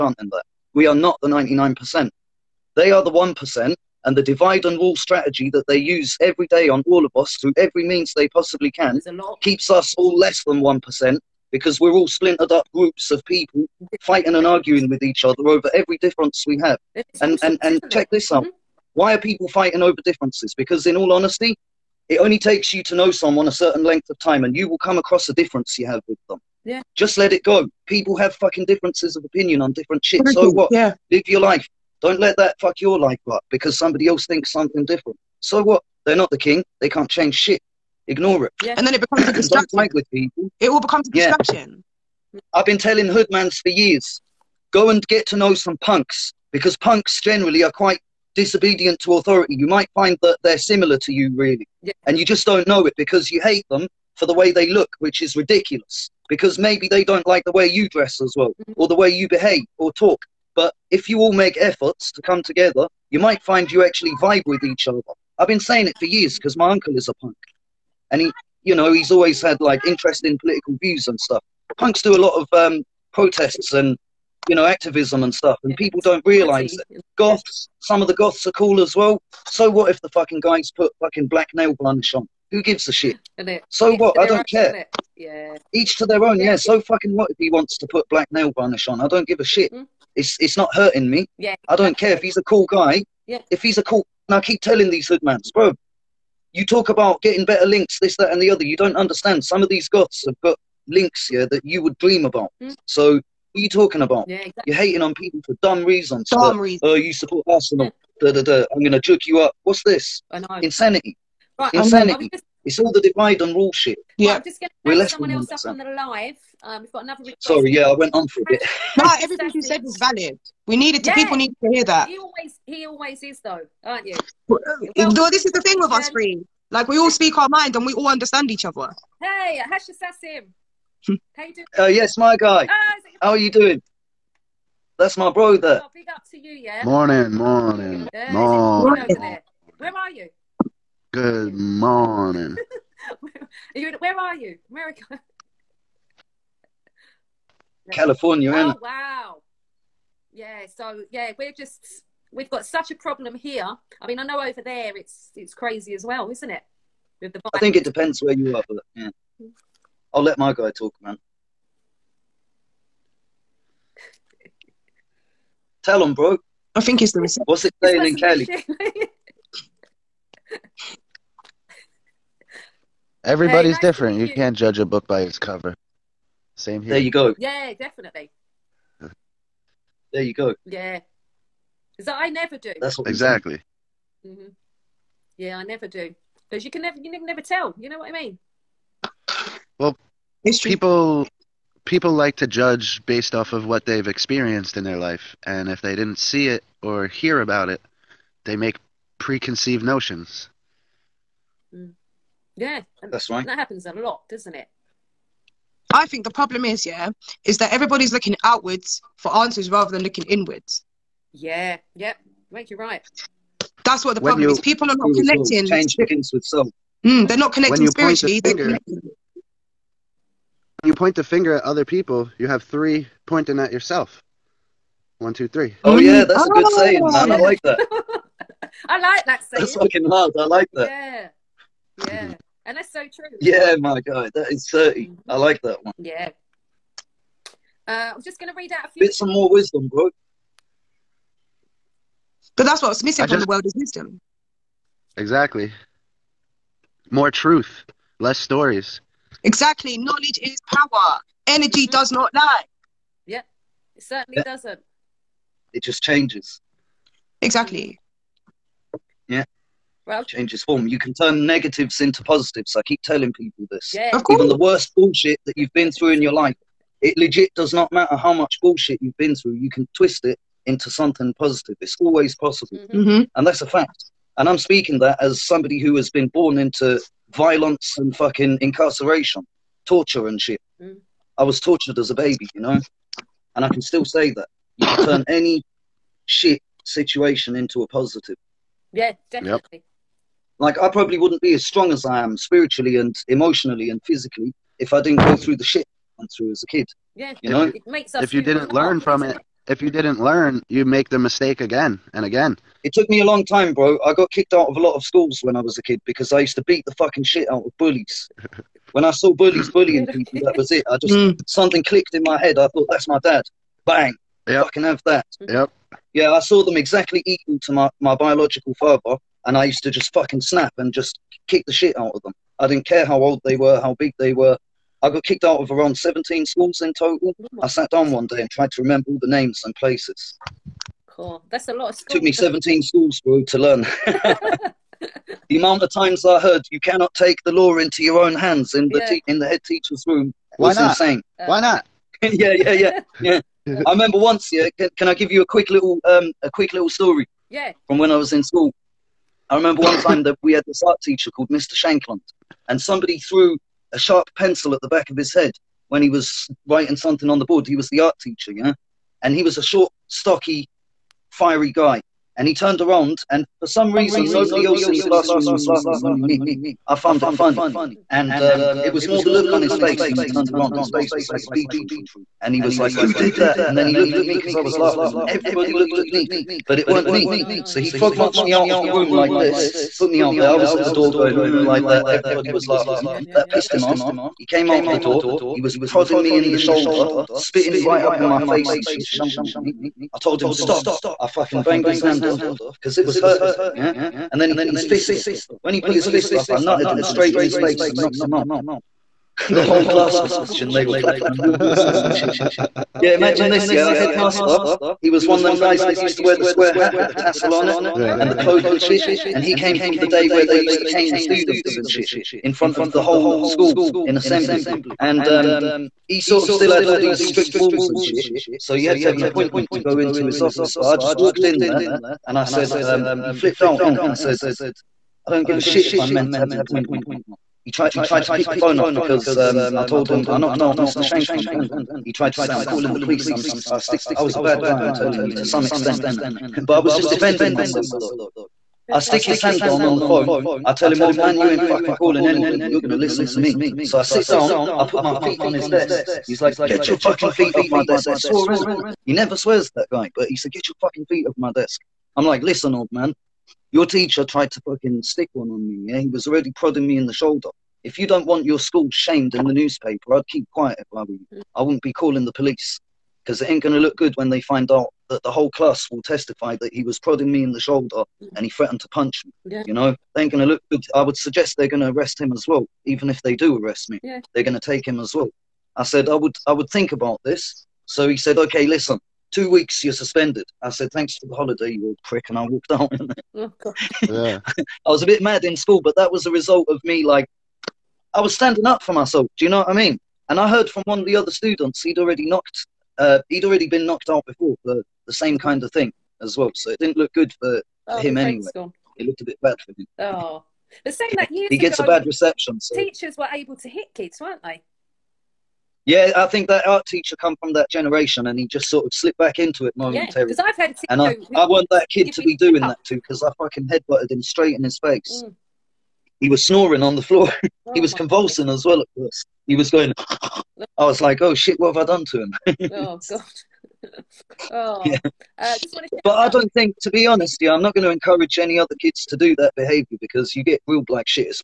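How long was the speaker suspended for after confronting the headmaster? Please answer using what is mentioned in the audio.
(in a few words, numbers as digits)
2 weeks.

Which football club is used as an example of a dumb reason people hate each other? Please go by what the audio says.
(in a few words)
Arsenal.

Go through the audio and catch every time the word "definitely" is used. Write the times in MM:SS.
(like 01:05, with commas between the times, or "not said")
02:57, 04:49.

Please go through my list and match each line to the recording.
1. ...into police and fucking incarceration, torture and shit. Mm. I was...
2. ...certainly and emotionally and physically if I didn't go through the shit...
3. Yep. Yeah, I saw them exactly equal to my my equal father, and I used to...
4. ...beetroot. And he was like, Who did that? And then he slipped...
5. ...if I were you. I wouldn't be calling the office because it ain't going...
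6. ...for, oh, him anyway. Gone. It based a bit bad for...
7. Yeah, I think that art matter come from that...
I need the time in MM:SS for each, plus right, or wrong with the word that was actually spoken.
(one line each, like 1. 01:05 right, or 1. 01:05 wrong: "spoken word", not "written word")
1. 04:36 wrong: "violence", not "police"
2. 04:52 wrong: "spiritually", not "certainly"
3. 05:15 wrong: "biological", not "equal"
4. 06:11 wrong: "looked", not "slipped"
5. 07:40 wrong: "police", not "office"
6. 08:17 wrong: "looked", not "based"
7. 08:25 wrong: "teacher", not "matter".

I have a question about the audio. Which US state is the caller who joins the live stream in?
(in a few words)
California.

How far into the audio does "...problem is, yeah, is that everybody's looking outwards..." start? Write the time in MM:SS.
03:26.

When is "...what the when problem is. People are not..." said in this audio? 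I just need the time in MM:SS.
03:34.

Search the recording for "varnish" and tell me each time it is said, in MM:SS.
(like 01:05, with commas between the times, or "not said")
01:21, 01:28.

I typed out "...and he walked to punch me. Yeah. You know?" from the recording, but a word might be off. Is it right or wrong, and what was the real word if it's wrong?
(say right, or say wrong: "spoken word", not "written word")
wrong: "threatened", not "walked".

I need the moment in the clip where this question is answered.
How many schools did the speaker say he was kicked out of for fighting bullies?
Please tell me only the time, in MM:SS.
05:25.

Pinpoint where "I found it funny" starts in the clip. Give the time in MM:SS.
06:06.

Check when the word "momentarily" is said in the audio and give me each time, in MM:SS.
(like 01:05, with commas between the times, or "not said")
08:29.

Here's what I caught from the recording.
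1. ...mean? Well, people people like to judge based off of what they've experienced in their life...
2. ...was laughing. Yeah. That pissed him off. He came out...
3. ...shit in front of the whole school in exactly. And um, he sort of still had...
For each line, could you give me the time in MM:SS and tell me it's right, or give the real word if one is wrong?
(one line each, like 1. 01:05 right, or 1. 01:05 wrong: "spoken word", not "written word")
1. 03:08 right
2. 06:22 right
3. 06:51 wrong: "assembly", not "exactly".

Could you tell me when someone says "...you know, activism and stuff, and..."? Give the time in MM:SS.
01:14.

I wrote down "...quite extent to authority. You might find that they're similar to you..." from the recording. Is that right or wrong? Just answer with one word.
wrong.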